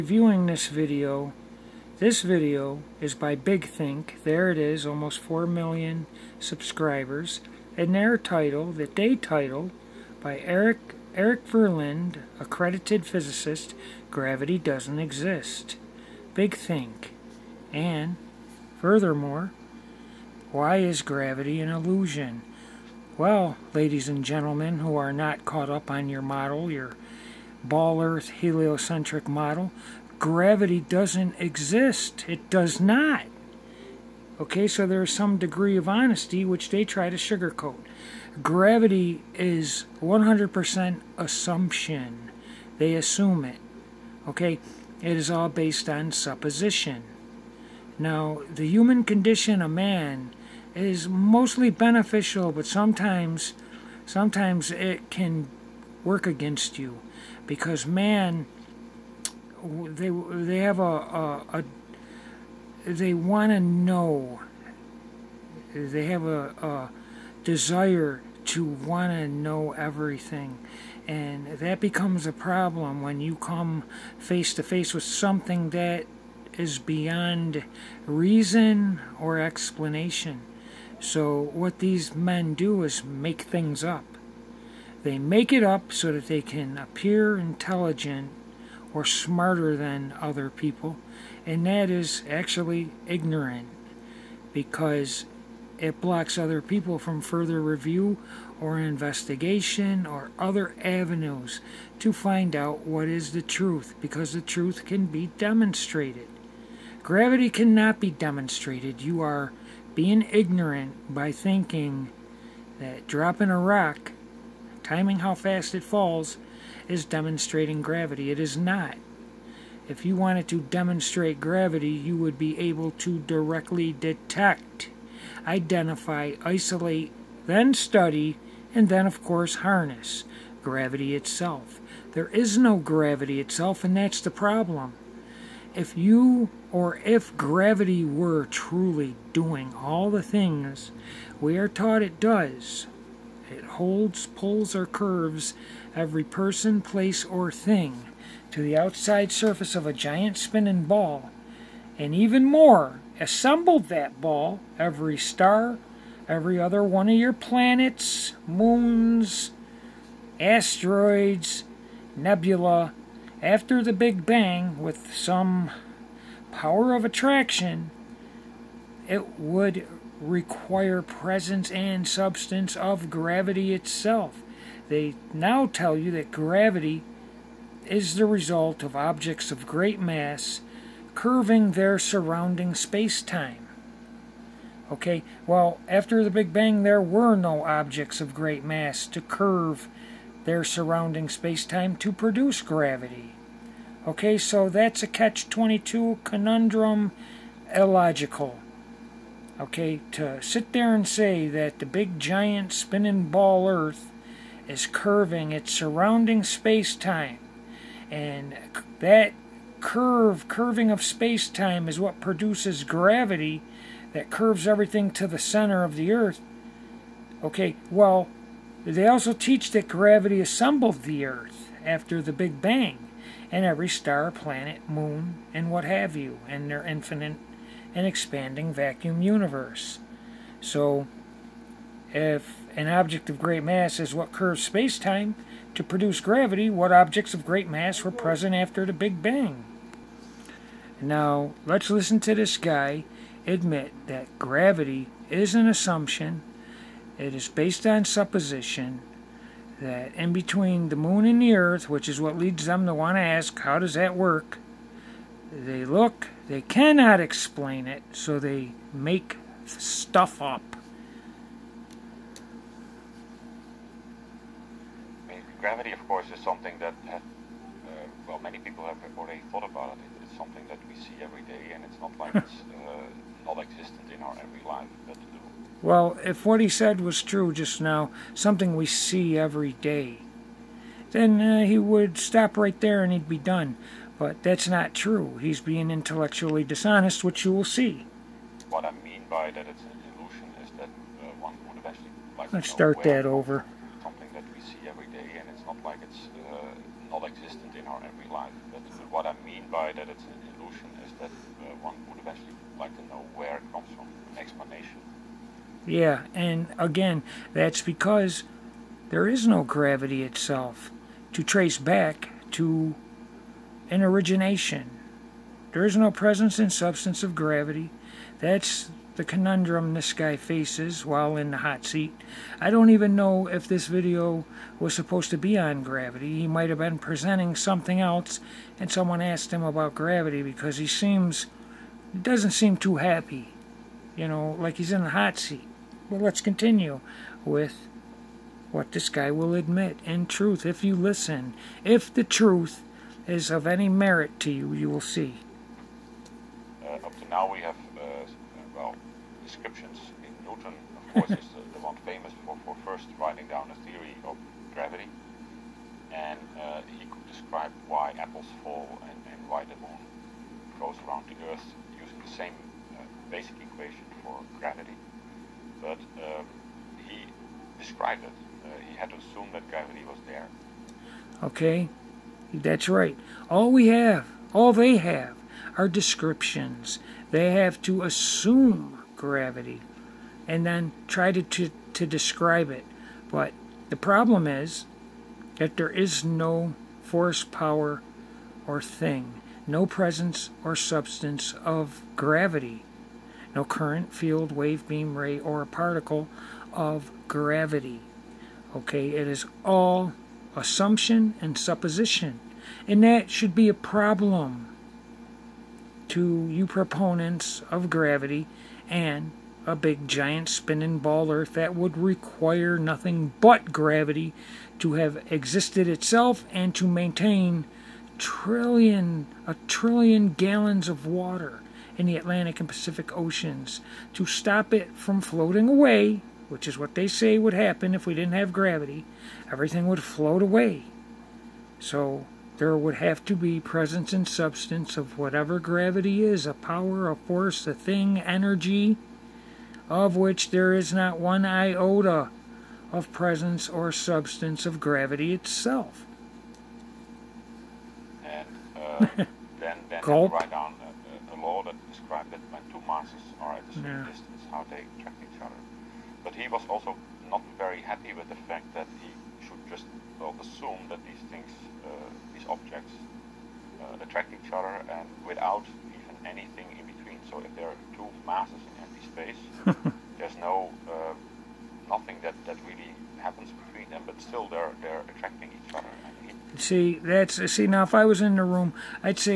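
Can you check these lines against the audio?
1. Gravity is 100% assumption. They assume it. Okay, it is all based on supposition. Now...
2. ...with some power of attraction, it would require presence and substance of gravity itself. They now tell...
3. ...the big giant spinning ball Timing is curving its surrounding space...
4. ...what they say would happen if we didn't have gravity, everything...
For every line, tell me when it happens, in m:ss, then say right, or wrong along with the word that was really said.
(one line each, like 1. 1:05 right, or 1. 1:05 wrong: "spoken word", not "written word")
1. 0:38 right
2. 2:44 right
3. 3:21 wrong: "Earth", not "Timing"
4. 7:06 right.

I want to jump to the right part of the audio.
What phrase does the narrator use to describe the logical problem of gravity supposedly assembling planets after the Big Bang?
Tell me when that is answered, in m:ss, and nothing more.
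3:15.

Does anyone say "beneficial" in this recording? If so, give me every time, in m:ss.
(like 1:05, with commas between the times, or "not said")
0:51.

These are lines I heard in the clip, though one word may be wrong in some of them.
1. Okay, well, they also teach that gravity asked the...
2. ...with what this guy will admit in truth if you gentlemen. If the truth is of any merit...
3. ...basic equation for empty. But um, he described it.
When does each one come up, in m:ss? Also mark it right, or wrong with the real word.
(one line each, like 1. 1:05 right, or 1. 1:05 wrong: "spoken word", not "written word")
1. 3:37 wrong: "assembled", not "asked"
2. 5:37 wrong: "listen", not "gentlemen"
3. 6:03 wrong: "gravity", not "empty".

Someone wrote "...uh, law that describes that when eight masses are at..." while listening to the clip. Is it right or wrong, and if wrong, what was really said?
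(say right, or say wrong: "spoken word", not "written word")
wrong: "two", not "eight".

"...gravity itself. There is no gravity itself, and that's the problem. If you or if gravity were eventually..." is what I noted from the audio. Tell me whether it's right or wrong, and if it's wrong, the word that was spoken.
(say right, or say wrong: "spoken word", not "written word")
wrong: "truly", not "eventually".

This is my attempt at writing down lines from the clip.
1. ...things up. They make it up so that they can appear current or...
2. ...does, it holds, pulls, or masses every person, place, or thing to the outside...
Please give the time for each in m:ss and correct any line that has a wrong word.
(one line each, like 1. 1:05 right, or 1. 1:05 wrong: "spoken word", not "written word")
1. 1:23 wrong: "intelligent", not "current"
2. 2:22 wrong: "curves", not "masses".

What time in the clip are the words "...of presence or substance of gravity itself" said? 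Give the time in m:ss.
7:22.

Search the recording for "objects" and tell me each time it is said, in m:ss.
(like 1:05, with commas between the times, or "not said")
2:58, 3:07, 3:52, 3:56, 7:42.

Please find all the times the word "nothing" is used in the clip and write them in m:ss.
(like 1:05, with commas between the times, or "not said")
6:52, 7:51.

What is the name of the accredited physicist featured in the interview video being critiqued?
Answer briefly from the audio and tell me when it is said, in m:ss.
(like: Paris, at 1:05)
Erik Verlinde, at 0:11.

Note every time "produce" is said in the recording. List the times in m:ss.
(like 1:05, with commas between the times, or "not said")
3:12, 3:32, 3:55.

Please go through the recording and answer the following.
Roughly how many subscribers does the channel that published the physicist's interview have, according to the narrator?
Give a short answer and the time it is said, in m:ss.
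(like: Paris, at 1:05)
almost 4 million, at 0:04.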